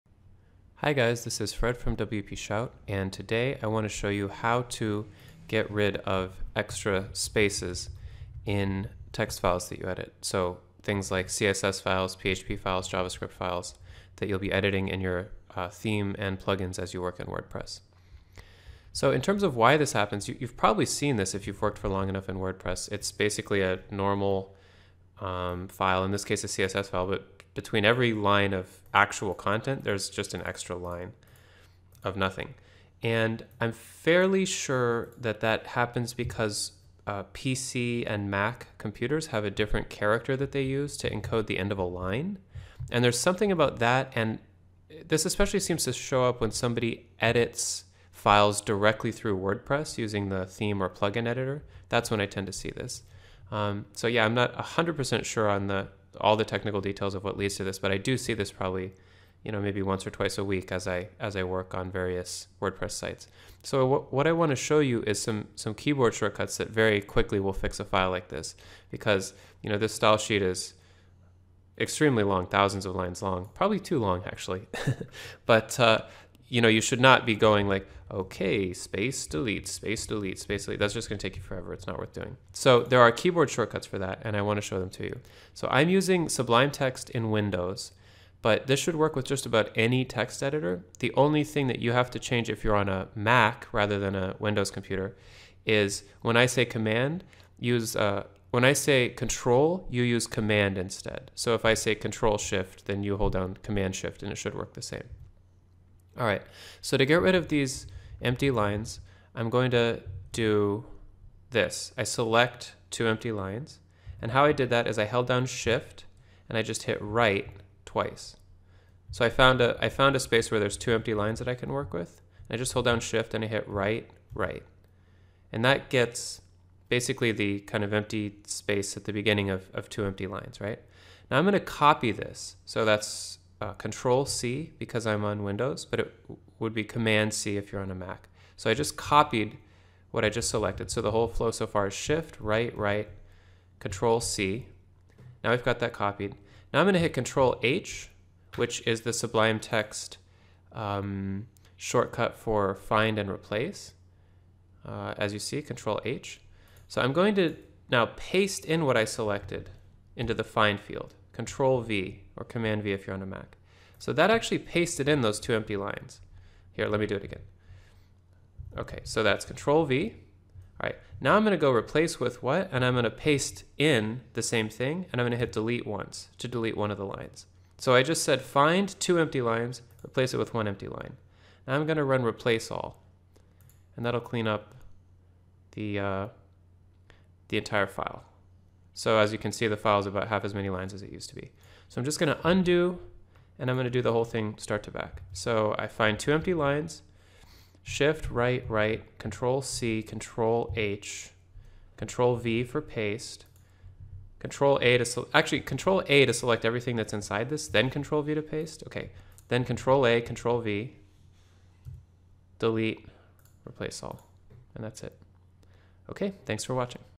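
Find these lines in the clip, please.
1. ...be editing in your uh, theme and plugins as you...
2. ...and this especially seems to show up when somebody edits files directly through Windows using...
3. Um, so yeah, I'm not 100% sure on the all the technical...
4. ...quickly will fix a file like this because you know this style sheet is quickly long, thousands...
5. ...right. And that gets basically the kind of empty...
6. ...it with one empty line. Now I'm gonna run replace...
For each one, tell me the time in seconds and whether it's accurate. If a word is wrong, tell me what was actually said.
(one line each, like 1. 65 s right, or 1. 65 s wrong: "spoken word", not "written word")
1. 14 s right
2. 44 s wrong: "WordPress", not "Windows"
3. 53 s right
4. 67 s wrong: "extremely", not "quickly"
5. 124 s right
6. 180 s right.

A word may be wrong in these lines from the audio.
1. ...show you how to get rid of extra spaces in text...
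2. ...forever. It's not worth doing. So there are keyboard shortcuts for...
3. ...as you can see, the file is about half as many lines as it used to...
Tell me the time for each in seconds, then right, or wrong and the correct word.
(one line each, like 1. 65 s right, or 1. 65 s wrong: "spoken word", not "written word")
1. 3 s right
2. 81 s right
3. 189 s right.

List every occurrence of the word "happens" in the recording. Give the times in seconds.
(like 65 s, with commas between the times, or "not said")
19 s, 35 s.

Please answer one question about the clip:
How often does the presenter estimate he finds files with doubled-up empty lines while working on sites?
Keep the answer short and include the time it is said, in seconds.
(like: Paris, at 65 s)
once or twice a week, at 59 s.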